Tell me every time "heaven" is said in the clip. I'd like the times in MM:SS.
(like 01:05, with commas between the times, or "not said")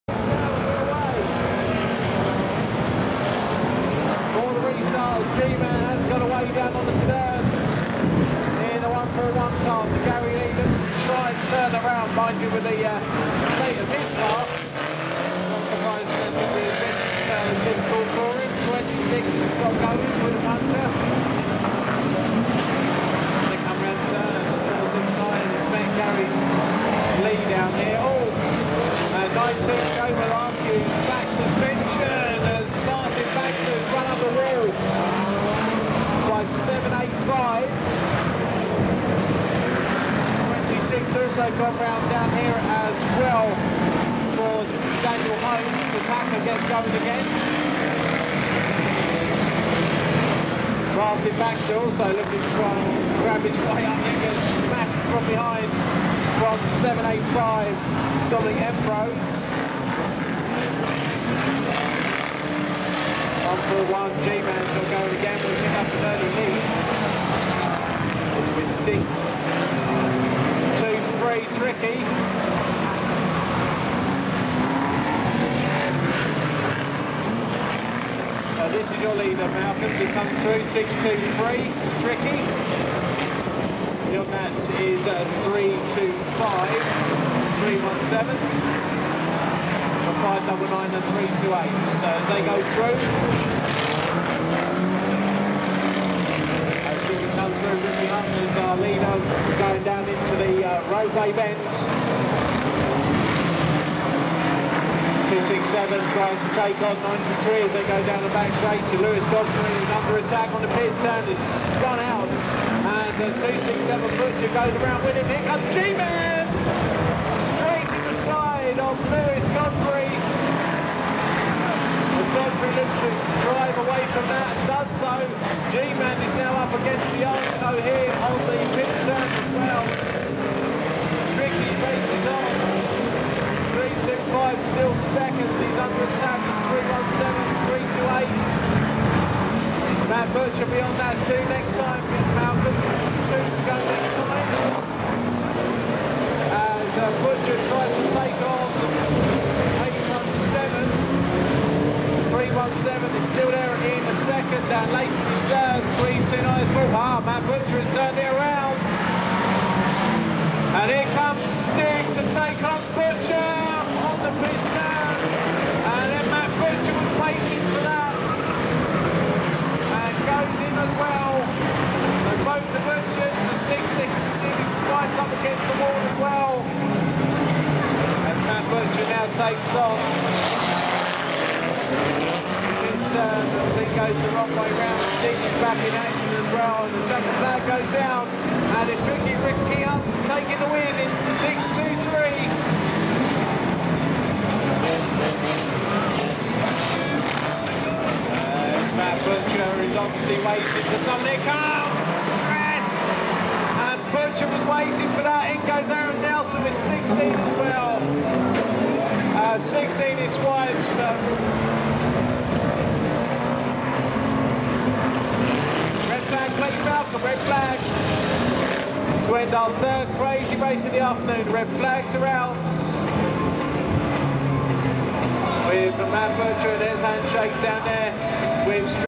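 not said.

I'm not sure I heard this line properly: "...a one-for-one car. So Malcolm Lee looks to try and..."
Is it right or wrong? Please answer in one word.
wrong.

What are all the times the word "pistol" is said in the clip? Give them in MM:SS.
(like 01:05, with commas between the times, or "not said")
02:44.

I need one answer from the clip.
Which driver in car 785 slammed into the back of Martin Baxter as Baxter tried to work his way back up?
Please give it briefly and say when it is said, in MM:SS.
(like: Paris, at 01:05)
Dominic Ambrose, at 00:58.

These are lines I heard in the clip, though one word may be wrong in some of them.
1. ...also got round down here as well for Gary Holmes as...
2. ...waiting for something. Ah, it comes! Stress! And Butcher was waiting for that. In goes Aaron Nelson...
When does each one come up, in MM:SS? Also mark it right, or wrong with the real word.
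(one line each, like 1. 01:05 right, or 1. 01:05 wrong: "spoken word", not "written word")
1. 00:41 wrong: "Daniel", not "Gary"
2. 03:20 right.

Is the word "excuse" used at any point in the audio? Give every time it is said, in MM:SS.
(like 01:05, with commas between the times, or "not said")
not said.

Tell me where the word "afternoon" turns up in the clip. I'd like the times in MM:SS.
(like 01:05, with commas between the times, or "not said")
03:40.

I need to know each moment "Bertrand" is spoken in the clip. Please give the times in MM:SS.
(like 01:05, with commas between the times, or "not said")
03:46.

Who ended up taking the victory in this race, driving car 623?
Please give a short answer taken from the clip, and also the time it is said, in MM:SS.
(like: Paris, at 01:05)
Ricky Hunt, at 03:09.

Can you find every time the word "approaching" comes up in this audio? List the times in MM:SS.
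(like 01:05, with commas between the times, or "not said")
not said.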